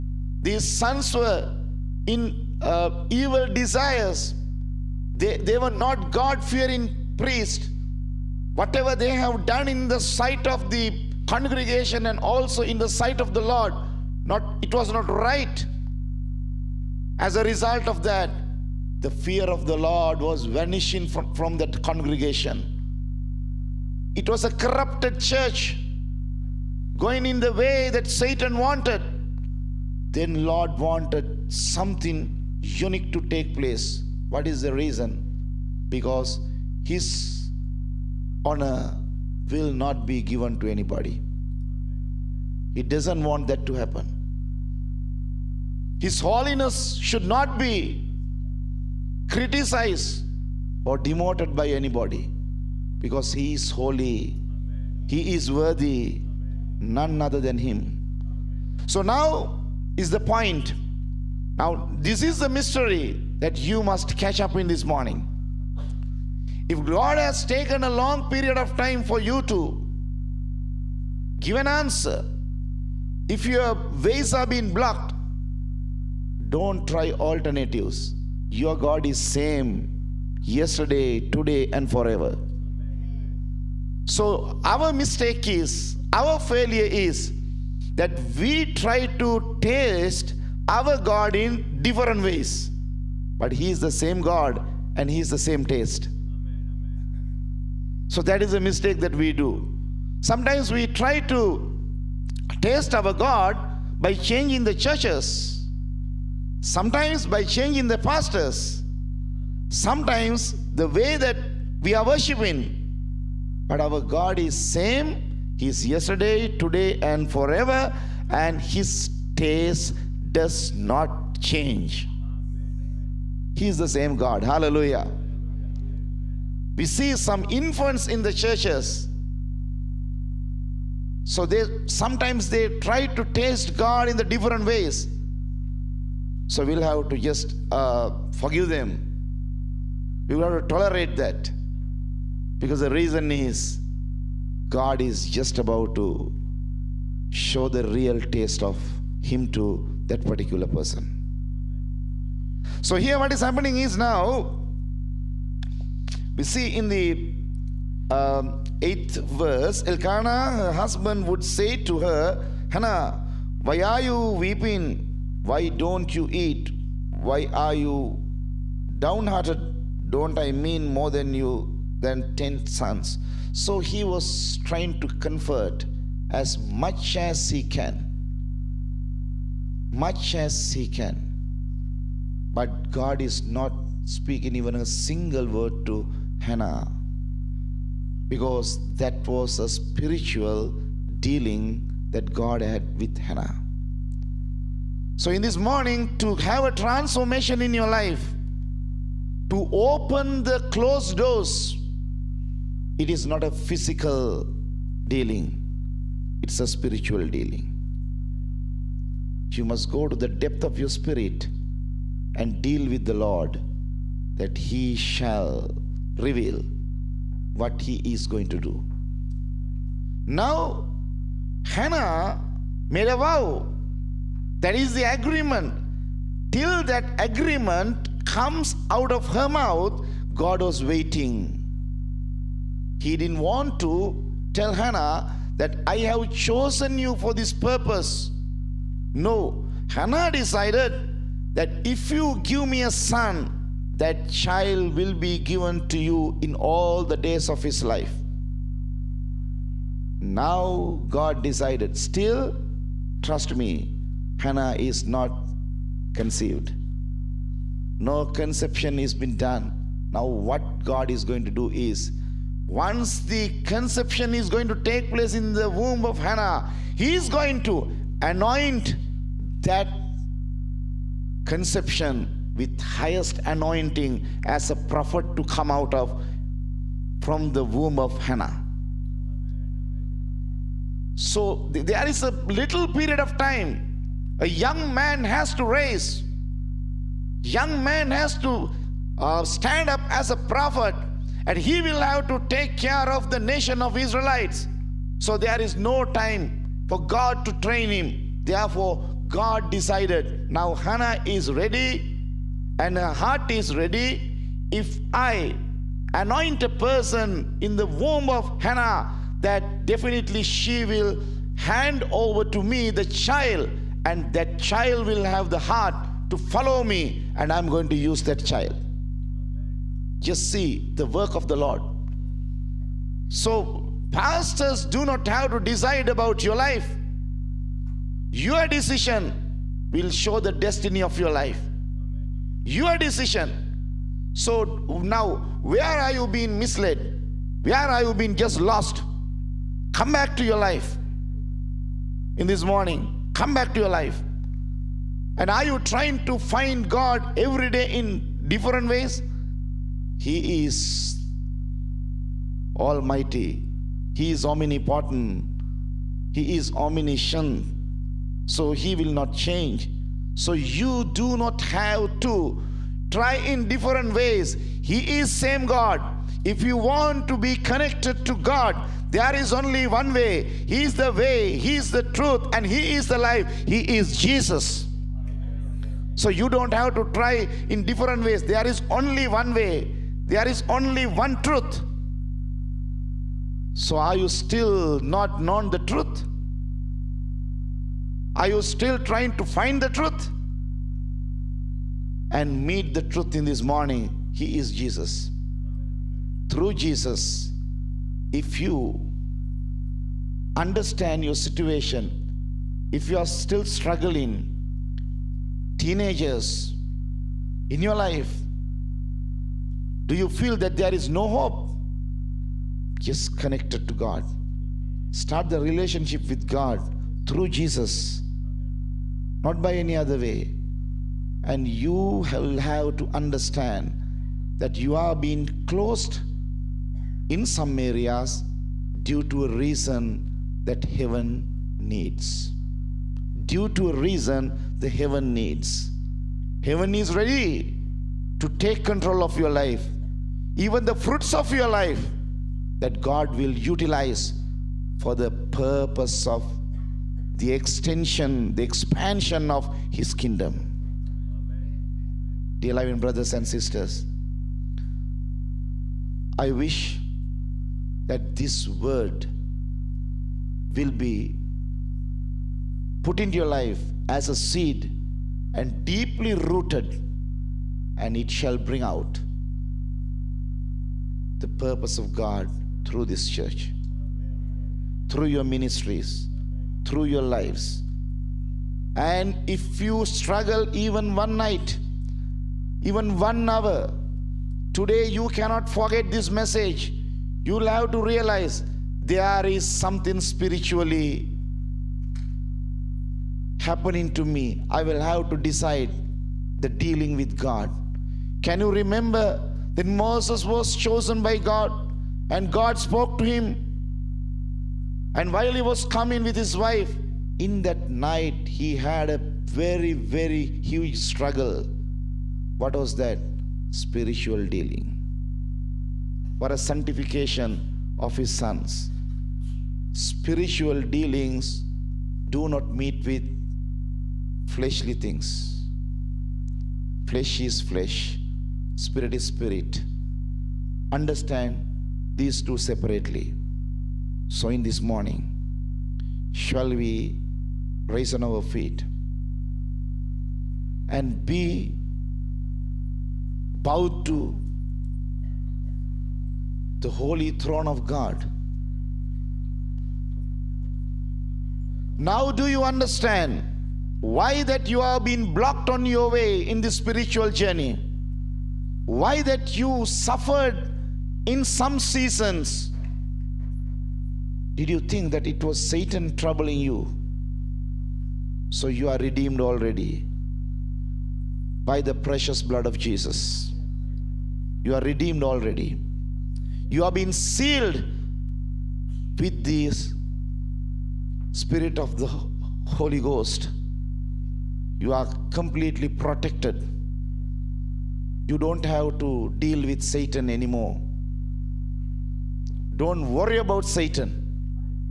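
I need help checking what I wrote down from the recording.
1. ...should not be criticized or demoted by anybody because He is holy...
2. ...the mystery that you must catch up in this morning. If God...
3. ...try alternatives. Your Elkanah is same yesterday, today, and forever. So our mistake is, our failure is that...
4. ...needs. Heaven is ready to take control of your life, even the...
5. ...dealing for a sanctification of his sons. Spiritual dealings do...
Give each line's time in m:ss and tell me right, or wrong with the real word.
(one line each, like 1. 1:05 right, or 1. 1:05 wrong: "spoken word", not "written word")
1. 0:46 right
2. 1:02 right
3. 1:16 wrong: "God", not "Elkanah"
4. 7:15 right
5. 8:34 right.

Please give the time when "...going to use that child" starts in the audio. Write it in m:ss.
5:17.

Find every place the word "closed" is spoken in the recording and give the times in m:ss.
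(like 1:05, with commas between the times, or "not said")
3:20, 7:05.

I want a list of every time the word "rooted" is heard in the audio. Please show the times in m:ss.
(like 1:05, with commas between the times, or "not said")
7:46.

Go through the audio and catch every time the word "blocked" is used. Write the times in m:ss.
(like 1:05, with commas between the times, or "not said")
1:14, 9:15.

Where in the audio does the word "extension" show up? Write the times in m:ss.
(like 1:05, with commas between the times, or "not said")
7:27.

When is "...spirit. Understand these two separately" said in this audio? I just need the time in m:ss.
8:49.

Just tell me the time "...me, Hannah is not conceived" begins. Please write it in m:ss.
4:13.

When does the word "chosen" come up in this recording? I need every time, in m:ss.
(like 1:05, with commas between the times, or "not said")
3:56, 8:20.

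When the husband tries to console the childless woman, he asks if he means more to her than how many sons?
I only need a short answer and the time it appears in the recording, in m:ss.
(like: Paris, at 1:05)
10, at 2:52.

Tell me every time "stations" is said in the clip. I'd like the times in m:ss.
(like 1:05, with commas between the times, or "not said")
not said.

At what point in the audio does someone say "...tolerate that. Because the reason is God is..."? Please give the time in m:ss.
2:20.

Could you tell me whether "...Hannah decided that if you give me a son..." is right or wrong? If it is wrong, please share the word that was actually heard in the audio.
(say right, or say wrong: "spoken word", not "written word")
right.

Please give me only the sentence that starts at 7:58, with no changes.
And if you struggle even one night, even one hour, today you cannot forget this message.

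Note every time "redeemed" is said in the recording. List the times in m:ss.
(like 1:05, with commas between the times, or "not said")
9:28, 9:34.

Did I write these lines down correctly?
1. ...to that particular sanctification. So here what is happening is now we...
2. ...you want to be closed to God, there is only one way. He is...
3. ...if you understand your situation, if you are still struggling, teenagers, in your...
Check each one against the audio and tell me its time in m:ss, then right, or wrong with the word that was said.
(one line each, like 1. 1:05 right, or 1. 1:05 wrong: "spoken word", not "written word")
1. 2:29 wrong: "person", not "sanctification"
2. 6:06 wrong: "connected", not "closed"
3. 6:38 right.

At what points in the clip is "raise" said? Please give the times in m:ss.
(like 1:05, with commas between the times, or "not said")
4:45, 8:57.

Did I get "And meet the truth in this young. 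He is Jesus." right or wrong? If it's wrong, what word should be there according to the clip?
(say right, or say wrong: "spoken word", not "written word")
wrong: "morning", not "young".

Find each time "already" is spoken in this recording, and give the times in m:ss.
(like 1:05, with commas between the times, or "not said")
9:29, 9:35.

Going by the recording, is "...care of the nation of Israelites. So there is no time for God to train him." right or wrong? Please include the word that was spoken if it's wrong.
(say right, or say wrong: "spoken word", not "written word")
right.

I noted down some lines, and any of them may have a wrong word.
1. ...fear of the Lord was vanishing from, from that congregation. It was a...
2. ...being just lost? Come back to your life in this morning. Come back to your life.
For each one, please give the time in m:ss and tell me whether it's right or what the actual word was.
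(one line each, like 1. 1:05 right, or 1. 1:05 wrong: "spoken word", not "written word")
1. 0:19 right
2. 5:38 right.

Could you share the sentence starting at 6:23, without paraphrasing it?
So are you still not known the truth?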